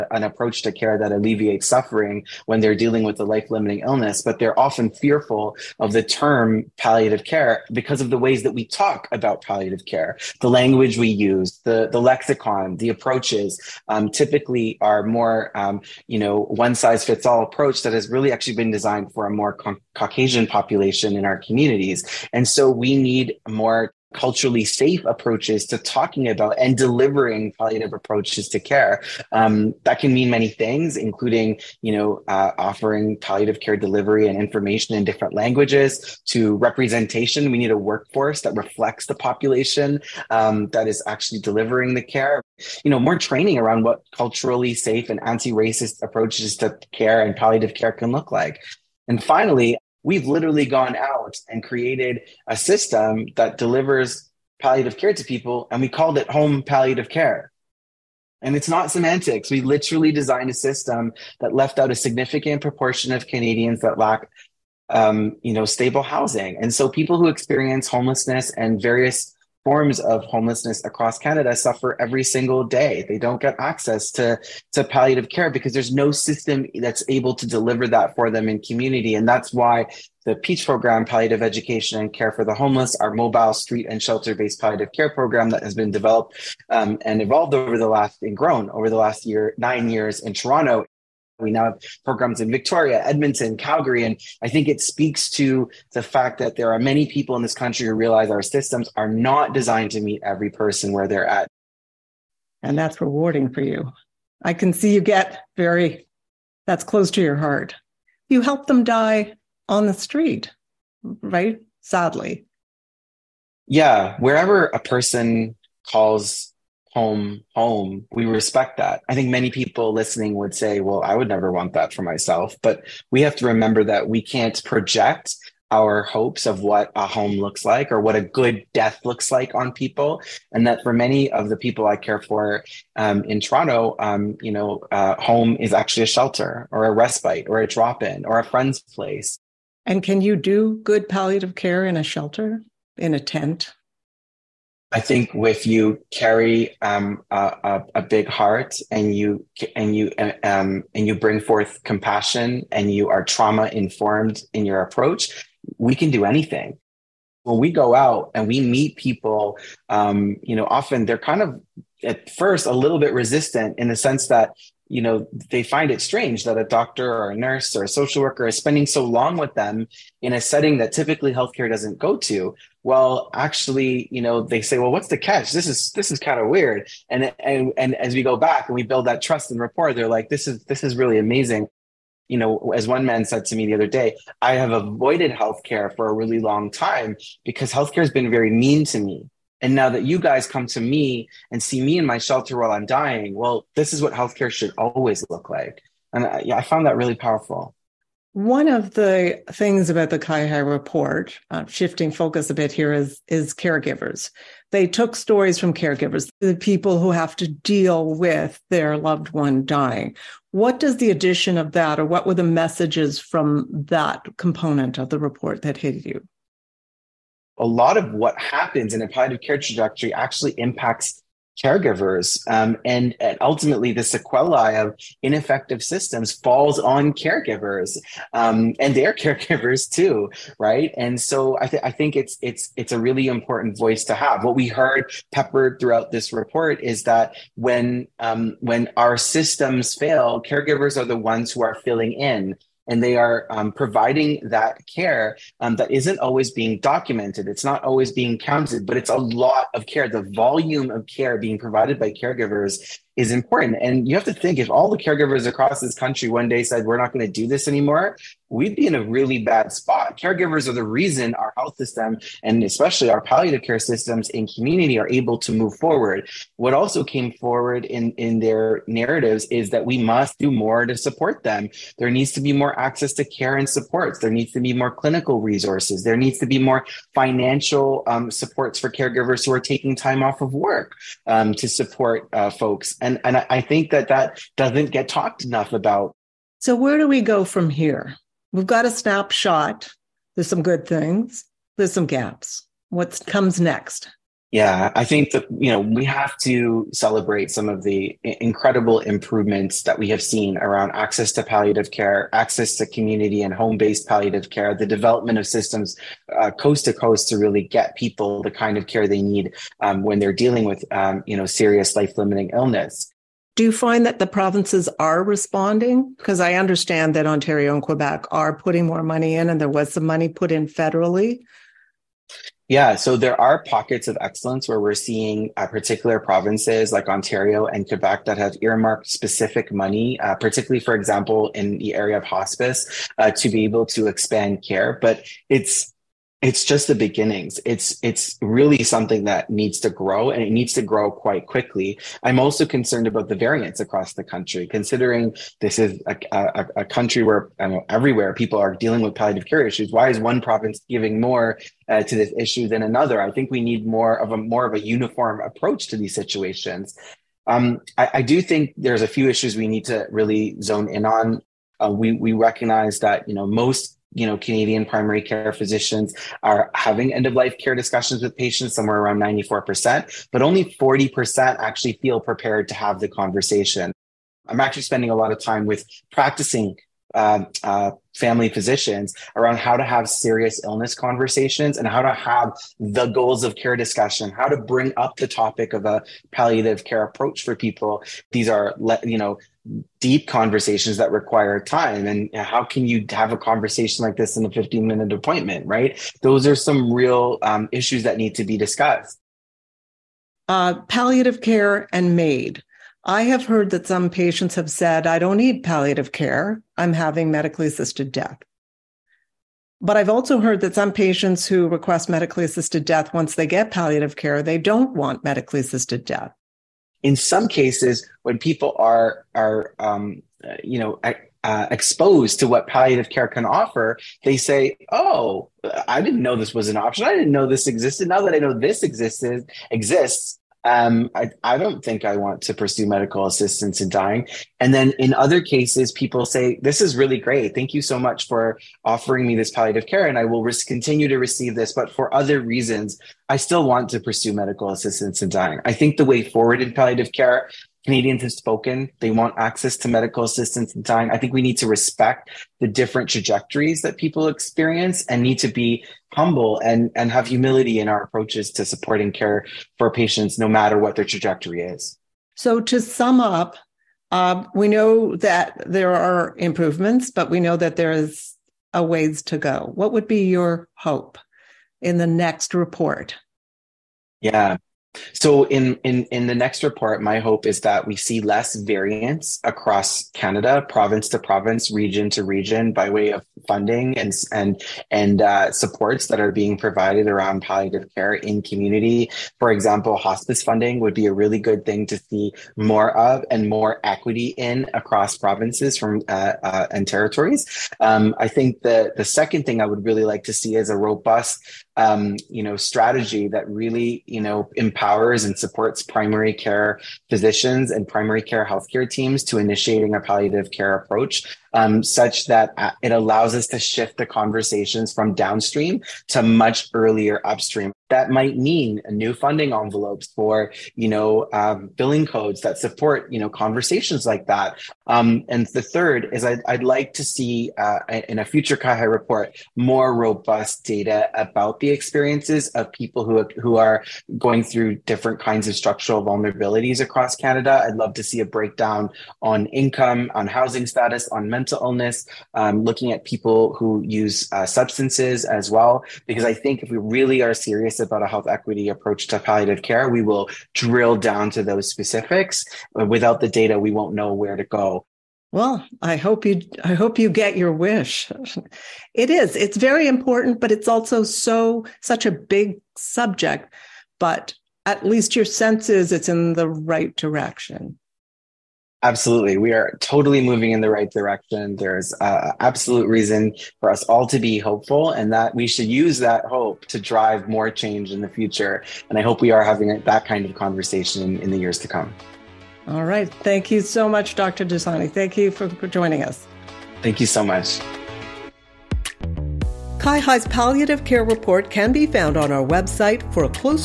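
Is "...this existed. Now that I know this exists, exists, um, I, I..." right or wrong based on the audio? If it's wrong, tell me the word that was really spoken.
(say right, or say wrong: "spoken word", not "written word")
right.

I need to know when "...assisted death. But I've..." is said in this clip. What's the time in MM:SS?
06:47.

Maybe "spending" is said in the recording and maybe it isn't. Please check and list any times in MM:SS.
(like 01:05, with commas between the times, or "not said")
02:48, 06:14.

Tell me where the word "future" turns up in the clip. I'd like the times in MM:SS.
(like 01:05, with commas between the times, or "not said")
08:48, 09:38.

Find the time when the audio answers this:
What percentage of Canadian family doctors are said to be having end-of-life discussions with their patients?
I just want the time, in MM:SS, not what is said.
06:09.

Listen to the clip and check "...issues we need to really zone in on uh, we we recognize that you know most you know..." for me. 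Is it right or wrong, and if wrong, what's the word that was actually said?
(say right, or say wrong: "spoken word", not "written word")
right.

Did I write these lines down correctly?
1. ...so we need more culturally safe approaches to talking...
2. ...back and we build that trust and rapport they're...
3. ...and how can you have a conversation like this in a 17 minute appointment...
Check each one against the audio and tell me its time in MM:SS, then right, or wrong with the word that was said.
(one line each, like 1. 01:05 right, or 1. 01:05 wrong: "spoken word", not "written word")
1. 00:22 right
2. 02:58 right
3. 06:32 wrong: "15", not "17".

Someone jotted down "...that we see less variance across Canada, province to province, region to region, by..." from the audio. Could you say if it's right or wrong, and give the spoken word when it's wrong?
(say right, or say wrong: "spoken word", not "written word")
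right.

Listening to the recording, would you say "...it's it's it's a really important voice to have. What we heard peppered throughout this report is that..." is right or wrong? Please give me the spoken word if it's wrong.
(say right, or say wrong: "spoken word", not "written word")
right.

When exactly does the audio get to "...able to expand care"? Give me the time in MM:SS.
05:33.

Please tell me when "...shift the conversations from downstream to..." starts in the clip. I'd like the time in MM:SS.
08:33.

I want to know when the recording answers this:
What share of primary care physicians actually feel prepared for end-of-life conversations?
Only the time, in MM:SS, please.
06:10.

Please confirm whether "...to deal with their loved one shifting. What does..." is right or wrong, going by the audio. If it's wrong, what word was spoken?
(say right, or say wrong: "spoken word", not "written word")
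wrong: "dying", not "shifting".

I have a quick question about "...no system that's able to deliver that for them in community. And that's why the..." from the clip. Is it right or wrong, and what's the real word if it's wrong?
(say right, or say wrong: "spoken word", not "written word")
right.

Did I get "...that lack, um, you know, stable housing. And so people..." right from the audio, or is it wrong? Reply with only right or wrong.
right.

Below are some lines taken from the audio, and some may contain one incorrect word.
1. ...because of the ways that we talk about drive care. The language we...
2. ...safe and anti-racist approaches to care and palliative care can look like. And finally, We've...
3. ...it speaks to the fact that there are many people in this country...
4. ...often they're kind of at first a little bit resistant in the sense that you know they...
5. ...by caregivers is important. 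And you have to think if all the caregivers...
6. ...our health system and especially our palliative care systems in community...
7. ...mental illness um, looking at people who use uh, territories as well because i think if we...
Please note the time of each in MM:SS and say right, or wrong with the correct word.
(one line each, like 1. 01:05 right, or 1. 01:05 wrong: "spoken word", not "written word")
1. 00:07 wrong: "palliative", not "drive"
2. 00:44 right
3. 01:34 right
4. 02:40 right
5. 04:11 right
6. 04:21 right
7. 09:01 wrong: "substances", not "territories".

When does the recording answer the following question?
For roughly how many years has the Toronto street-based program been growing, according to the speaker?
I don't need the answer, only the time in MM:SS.
01:29.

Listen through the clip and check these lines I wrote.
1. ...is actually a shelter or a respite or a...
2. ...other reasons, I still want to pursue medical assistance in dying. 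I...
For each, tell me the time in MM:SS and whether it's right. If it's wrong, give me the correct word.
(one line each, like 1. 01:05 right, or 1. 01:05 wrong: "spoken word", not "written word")
1. 02:15 right
2. 07:22 right.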